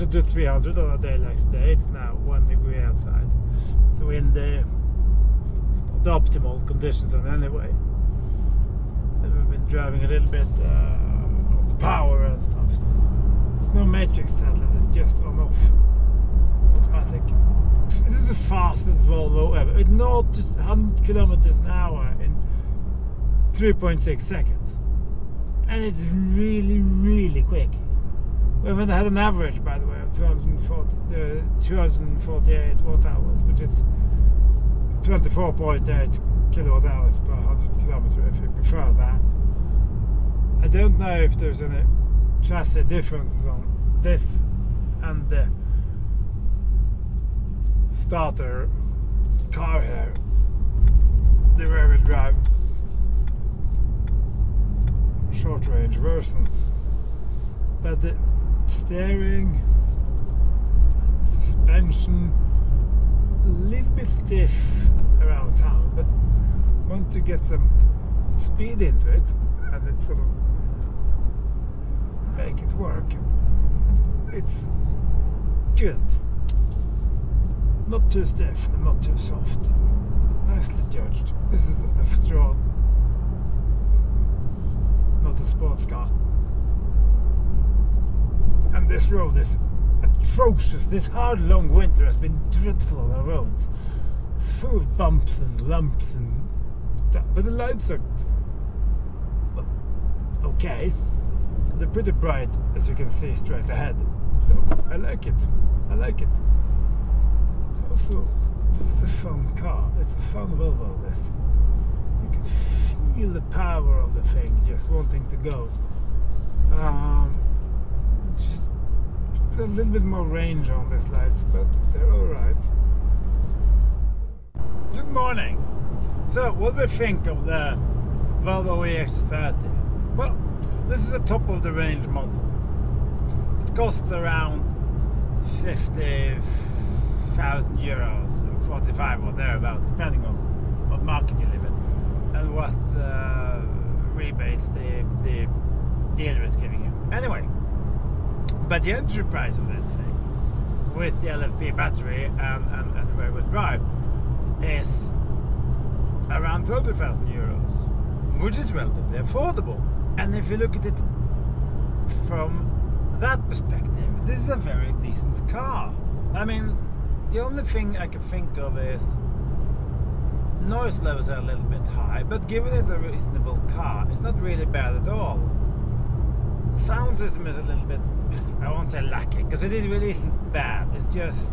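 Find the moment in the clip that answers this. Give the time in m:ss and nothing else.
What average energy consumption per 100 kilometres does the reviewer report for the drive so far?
0:35.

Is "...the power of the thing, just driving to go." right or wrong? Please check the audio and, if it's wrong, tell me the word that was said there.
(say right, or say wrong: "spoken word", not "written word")
wrong: "wanting", not "driving".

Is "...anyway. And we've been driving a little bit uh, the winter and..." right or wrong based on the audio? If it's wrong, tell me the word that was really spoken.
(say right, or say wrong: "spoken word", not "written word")
wrong: "power", not "winter".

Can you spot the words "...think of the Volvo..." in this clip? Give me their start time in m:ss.
2:06.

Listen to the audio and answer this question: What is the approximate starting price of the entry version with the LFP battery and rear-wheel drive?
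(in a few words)
30,000 euros.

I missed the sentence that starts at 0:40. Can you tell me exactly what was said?
I don't know if there's any chassis differences on this and the starter car here, the rear-wheel drive short-range version.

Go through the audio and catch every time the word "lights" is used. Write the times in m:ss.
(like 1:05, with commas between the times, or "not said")
1:37, 2:01.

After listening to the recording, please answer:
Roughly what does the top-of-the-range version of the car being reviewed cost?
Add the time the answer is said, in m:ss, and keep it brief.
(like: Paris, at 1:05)
50,000 euros, at 2:15.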